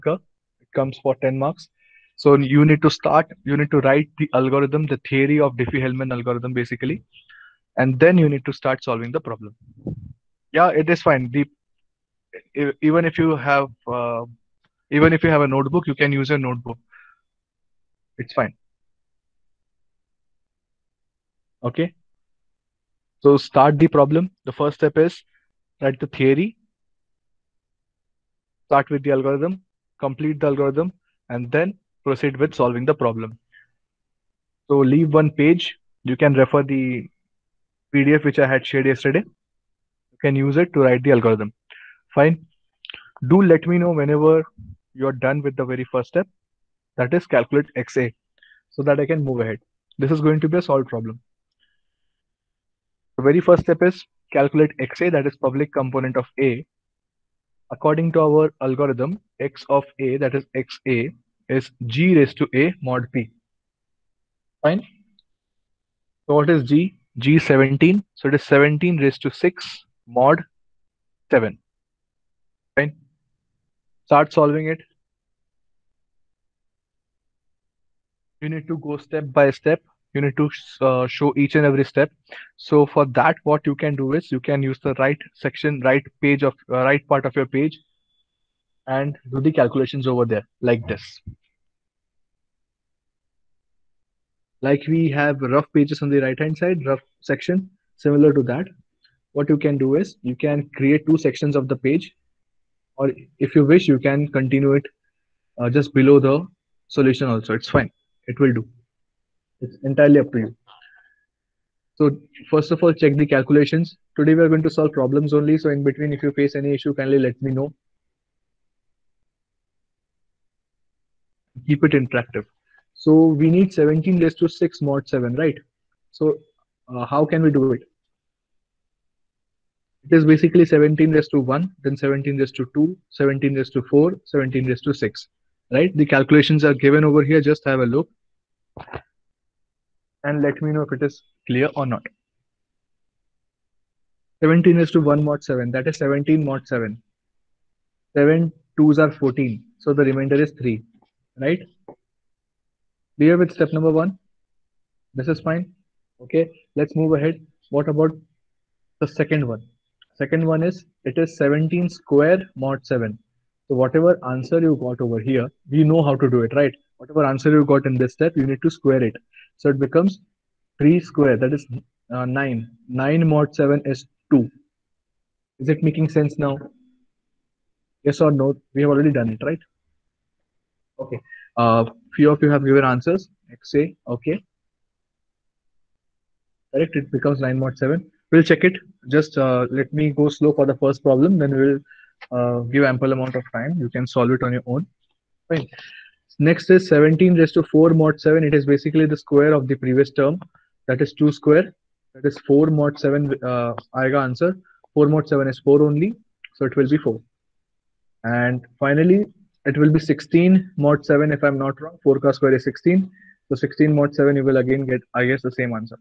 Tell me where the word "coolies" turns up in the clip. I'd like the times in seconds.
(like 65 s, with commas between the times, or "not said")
not said.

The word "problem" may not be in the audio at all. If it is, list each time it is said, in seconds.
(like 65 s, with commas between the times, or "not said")
9 s, 23 s, 33 s, 50 s, 114 s, 191 s.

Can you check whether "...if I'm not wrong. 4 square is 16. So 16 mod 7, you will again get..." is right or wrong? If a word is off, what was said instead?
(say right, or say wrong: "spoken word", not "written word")
right.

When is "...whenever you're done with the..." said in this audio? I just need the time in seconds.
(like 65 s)
43 s.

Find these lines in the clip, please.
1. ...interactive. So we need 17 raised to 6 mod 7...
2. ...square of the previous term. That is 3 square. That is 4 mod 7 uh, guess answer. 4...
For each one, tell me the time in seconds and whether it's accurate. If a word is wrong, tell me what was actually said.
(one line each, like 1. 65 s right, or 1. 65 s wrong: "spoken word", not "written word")
1. 121 s right
2. 199 s wrong: "2", not "3".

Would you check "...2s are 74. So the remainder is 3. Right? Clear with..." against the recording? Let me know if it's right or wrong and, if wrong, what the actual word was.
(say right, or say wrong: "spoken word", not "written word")
wrong: "14", not "74".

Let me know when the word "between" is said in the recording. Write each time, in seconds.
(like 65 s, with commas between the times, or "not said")
115 s.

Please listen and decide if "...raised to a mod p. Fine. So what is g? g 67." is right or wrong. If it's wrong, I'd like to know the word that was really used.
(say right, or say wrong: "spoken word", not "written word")
wrong: "17", not "67".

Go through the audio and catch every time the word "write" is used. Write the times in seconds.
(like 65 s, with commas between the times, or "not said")
3 s, 25 s, 40 s.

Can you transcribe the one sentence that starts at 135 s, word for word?
The calculations are given over here.